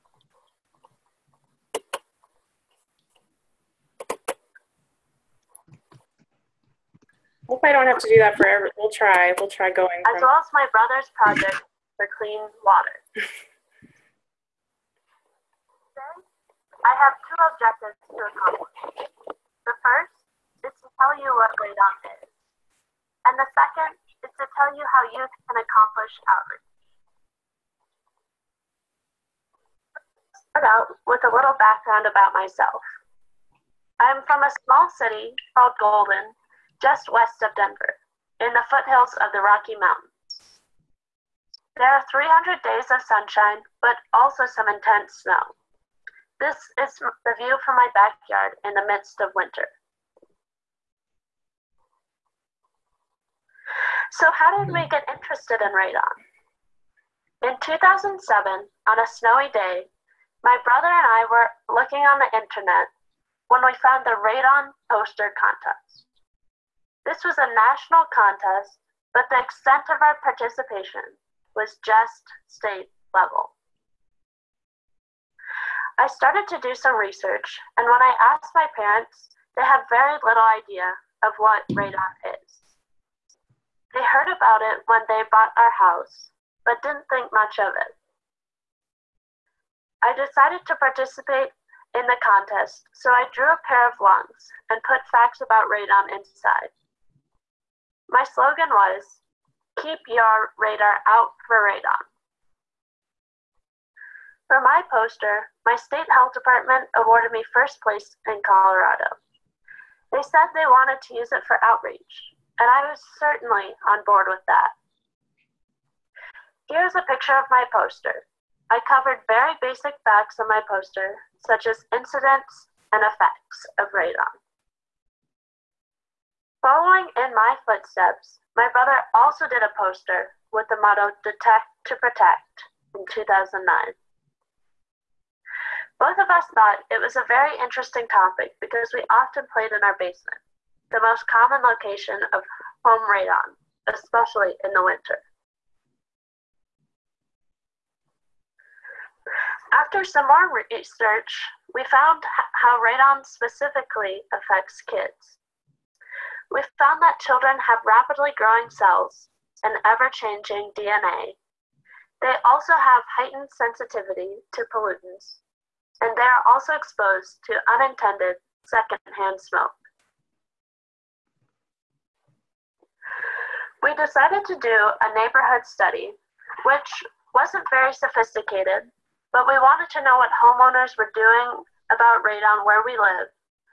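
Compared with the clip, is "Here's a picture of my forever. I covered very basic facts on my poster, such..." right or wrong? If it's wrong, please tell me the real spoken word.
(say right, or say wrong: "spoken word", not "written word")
wrong: "poster", not "forever".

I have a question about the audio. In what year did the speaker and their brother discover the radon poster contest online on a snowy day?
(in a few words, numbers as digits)
2007.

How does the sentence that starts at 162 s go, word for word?
They also have heightened sensitivity to pollutants, and they are also exposed to unintended secondhand smoke.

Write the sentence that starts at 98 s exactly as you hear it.
My slogan was keep your radar out for radon.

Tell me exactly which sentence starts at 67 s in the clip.
This was a national contest, but the extent of our participation was just state level.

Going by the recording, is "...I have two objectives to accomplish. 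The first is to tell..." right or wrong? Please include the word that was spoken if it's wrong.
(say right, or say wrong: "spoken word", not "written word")
right.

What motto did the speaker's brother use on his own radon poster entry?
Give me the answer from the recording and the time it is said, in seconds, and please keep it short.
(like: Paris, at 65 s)
Detect to Protect, at 131 s.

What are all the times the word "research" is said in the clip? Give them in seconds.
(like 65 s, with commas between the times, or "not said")
76 s, 150 s.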